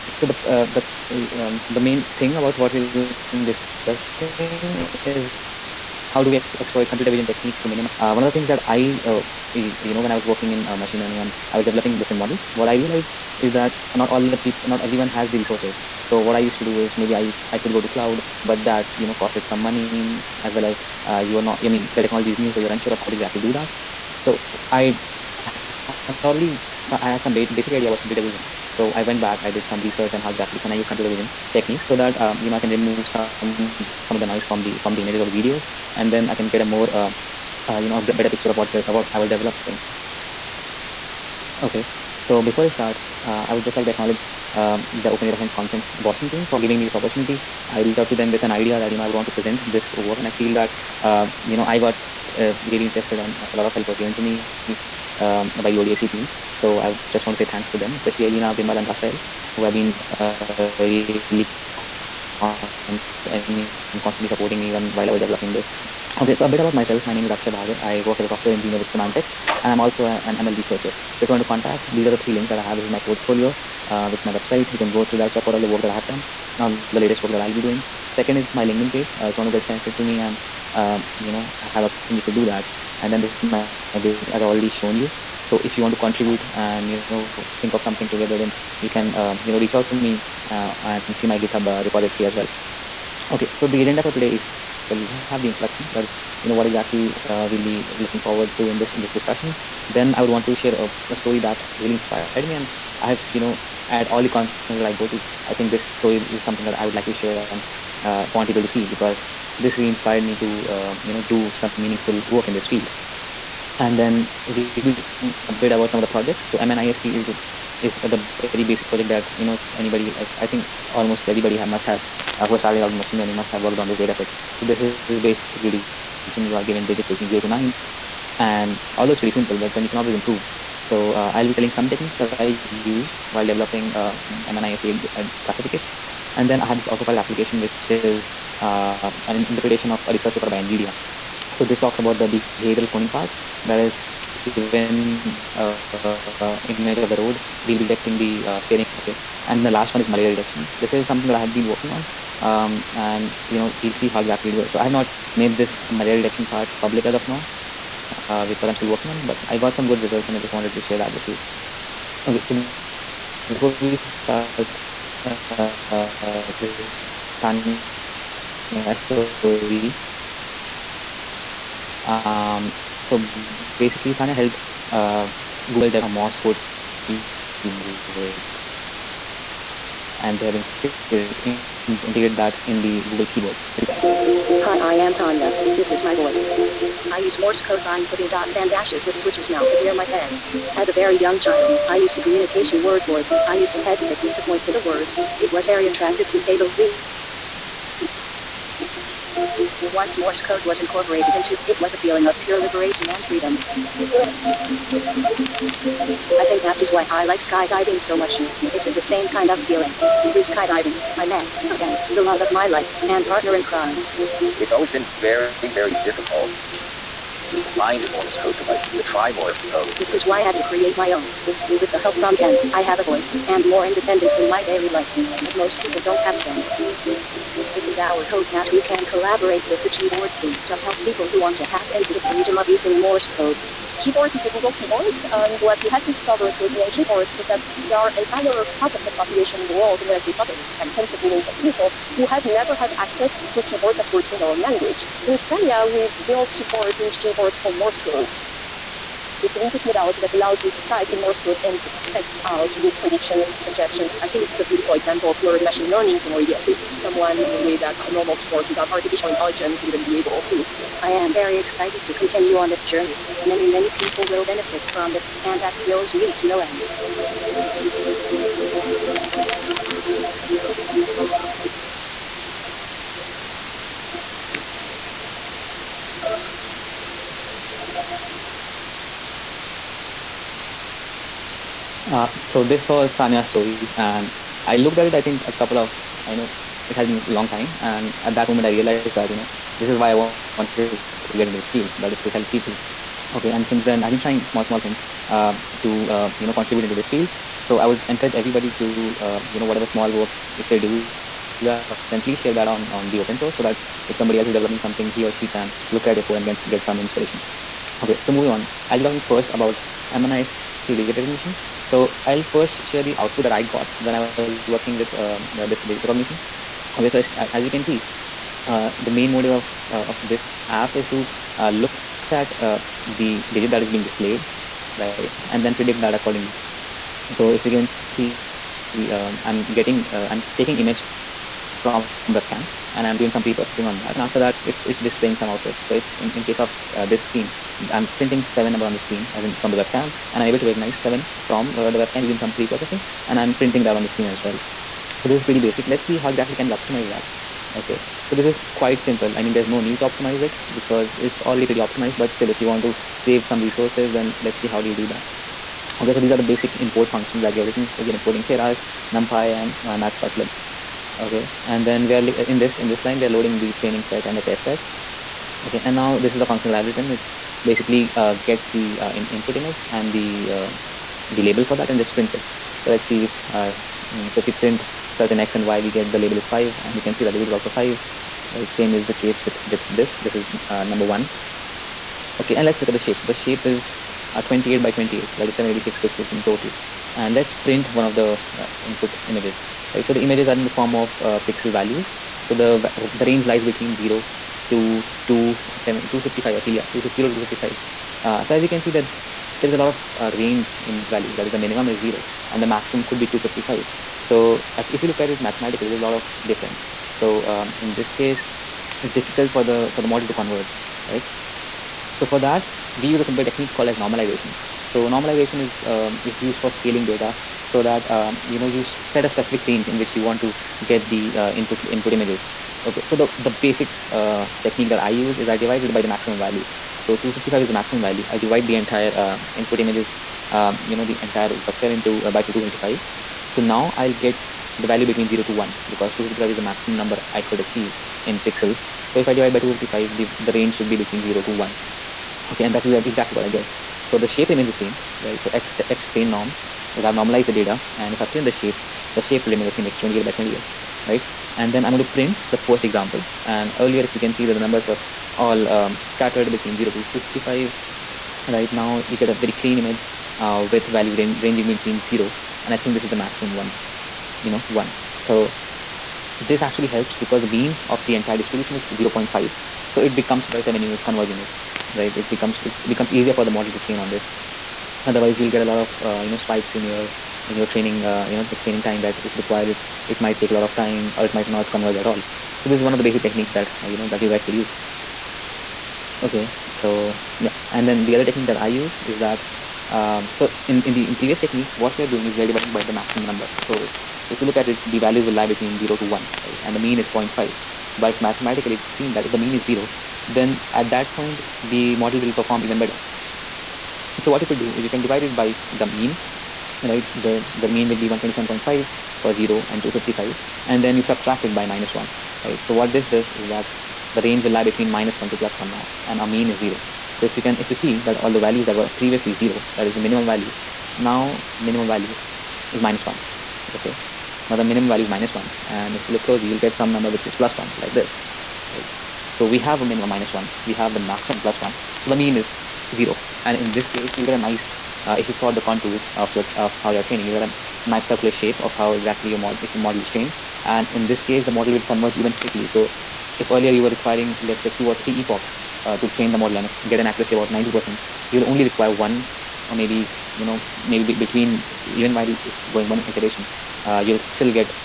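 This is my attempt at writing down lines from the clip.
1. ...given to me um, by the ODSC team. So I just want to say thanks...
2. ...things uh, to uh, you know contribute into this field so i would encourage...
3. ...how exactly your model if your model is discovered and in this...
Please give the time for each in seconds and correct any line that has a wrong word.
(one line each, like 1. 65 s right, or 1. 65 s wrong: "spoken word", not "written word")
1. 54 s right
2. 294 s right
3. 538 s wrong: "trained", not "discovered".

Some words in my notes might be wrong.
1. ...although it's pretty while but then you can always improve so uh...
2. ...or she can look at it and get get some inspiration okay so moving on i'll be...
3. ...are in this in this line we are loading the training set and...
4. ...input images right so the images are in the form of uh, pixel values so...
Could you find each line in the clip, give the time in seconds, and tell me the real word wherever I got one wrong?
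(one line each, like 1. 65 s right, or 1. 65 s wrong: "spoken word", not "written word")
1. 128 s wrong: "simple", not "while"
2. 305 s right
3. 362 s right
4. 388 s right.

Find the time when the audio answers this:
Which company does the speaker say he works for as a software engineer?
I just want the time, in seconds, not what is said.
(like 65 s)
68 s.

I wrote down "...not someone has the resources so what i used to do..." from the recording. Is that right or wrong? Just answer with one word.
wrong.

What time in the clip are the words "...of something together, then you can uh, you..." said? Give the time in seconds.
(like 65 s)
87 s.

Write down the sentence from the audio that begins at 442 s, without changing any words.
Okay, and that's exactly what I get.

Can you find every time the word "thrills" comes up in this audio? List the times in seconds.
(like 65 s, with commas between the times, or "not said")
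265 s.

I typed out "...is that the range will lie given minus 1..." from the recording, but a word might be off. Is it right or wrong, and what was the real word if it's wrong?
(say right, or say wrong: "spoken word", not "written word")
wrong: "between", not "given".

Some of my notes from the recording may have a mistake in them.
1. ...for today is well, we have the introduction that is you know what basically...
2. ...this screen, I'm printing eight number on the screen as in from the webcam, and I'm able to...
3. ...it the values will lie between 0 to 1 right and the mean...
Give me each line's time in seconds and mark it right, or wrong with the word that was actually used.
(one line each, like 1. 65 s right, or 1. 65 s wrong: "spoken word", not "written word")
1. 94 s wrong: "exactly", not "basically"
2. 337 s wrong: "seven", not "eight"
3. 494 s right.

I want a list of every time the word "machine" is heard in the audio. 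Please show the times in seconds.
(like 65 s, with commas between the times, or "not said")
10 s, 122 s, 255 s.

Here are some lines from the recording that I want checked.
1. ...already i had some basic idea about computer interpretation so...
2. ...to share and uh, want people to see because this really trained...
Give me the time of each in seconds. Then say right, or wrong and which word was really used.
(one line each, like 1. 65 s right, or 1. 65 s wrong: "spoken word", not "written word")
1. 26 s wrong: "vision", not "interpretation"
2. 107 s wrong: "inspired", not "trained".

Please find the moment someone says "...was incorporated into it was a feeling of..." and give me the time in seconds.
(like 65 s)
200 s.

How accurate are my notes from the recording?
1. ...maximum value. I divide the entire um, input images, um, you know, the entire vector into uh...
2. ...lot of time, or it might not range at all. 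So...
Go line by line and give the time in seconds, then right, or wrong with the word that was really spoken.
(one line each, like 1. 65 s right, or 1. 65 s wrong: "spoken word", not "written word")
1. 427 s right
2. 480 s wrong: "converge", not "range".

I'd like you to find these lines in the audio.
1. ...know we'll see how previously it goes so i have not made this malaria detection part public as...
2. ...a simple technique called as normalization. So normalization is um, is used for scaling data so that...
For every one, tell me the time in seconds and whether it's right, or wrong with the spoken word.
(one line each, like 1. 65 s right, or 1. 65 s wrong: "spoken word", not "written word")
1. 153 s wrong: "exactly", not "previously"
2. 413 s right.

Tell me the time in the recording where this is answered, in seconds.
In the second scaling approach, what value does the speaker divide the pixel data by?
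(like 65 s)
508 s.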